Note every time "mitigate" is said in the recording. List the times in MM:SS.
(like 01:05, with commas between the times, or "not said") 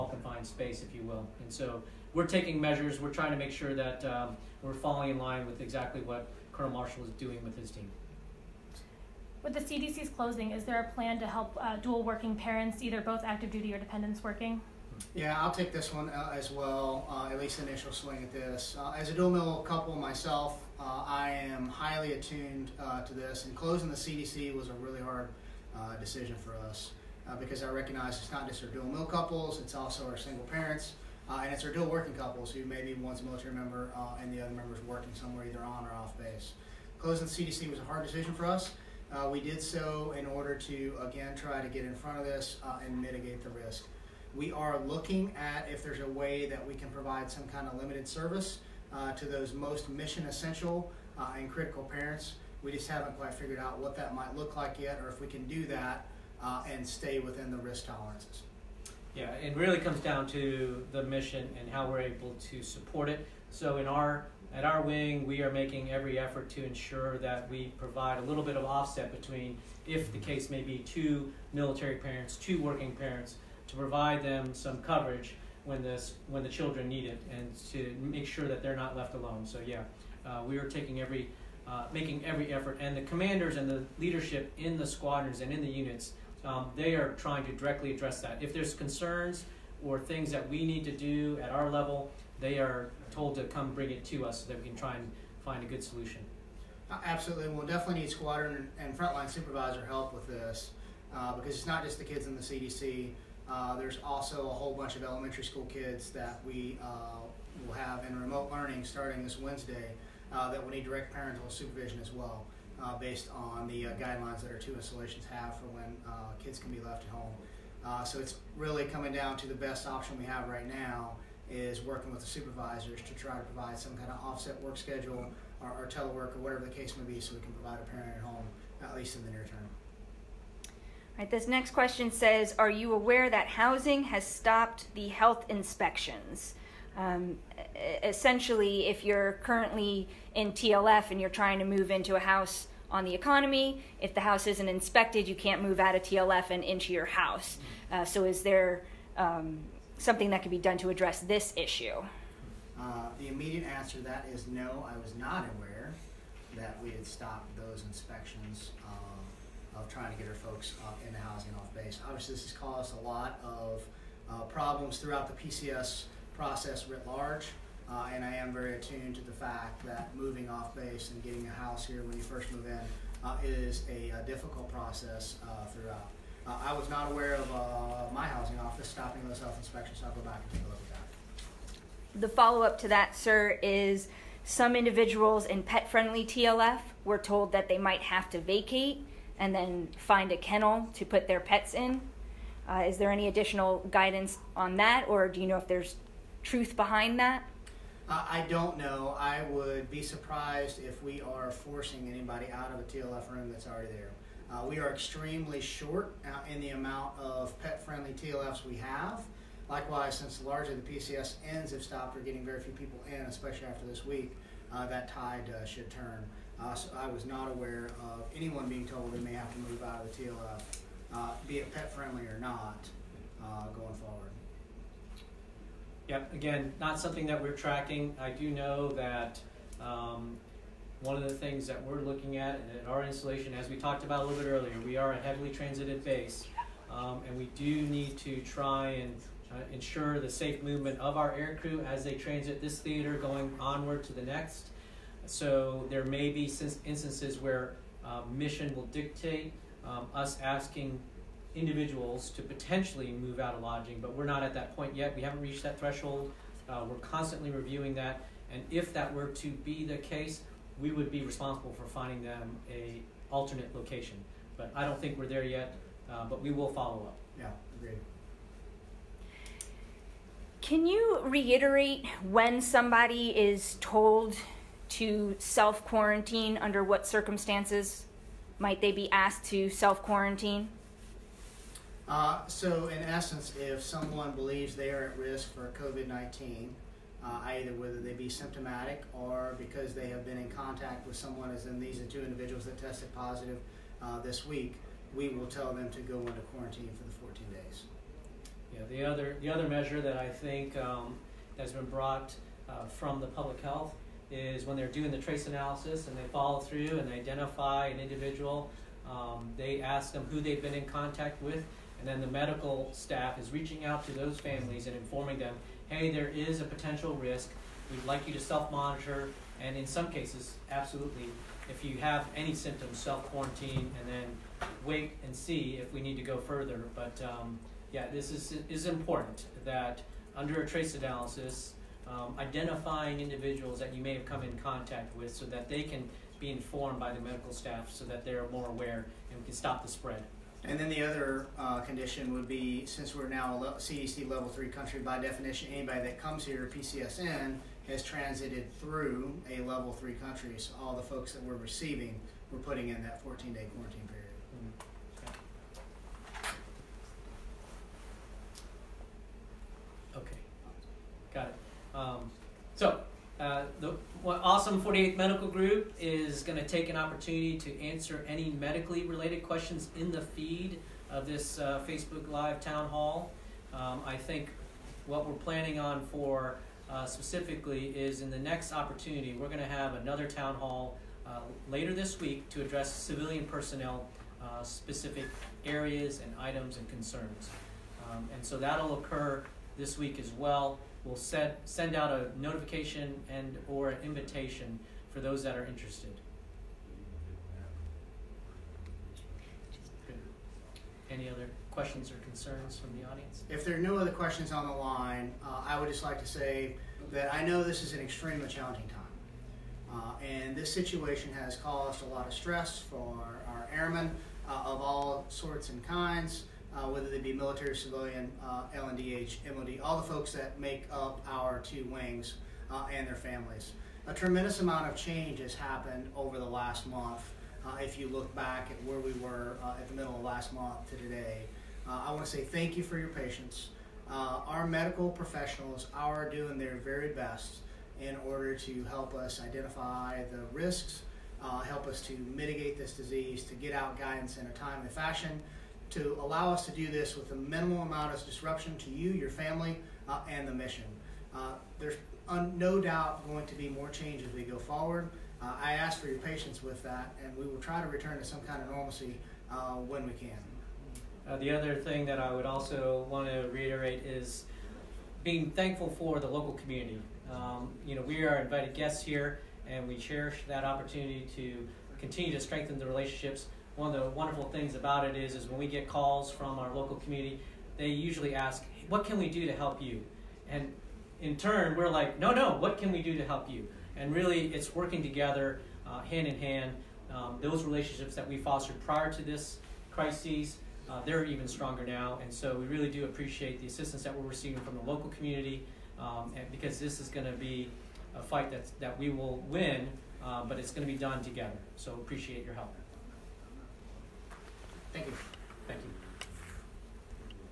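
00:43, 07:22.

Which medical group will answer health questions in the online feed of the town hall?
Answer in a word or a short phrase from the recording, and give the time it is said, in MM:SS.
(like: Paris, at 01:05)
Forty Eighth Medical Group, at 06:04.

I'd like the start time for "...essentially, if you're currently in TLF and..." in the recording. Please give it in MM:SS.
02:18.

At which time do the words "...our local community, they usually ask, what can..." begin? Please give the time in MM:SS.
07:56.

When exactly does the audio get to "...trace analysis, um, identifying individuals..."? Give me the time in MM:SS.
05:30.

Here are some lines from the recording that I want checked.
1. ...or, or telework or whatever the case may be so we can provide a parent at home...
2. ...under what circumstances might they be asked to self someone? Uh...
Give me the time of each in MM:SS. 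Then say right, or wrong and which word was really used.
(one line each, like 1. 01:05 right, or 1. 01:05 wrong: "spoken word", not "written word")
1. 02:05 right
2. 04:36 wrong: "quarantine", not "someone".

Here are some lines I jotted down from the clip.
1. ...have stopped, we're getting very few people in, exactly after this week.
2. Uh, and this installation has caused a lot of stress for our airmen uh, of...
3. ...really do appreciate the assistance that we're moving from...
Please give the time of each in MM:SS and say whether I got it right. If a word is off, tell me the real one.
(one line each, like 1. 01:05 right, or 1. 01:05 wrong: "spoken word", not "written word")
1. 03:31 wrong: "especially", not "exactly"
2. 06:49 wrong: "situation", not "installation"
3. 08:12 wrong: "receiving", not "moving".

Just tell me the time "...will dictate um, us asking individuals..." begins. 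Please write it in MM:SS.
04:08.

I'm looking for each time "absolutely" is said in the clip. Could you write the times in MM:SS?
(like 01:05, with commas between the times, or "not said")
01:37, 05:20.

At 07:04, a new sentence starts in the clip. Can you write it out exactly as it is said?
A tremendous amount of change has happened over the last month.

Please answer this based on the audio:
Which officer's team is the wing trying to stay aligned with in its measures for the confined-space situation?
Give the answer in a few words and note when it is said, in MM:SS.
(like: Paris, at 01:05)
Colonel Marshall, at 00:06.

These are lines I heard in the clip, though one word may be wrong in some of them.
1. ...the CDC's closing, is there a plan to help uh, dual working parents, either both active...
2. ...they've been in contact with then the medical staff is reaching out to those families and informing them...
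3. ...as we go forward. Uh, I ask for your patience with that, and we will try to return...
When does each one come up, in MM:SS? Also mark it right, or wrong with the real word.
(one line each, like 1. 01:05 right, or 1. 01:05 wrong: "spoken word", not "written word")
1. 00:09 right
2. 05:10 right
3. 07:34 right.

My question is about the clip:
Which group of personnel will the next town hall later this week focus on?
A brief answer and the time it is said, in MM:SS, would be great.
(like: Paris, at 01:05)
Civilian personnel, at 06:22.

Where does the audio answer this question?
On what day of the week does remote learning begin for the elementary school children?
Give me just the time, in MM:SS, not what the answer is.
01:49.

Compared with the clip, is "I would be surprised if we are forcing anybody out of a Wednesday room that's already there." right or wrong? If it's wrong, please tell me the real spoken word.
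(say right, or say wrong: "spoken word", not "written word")
wrong: "TLF", not "Wednesday".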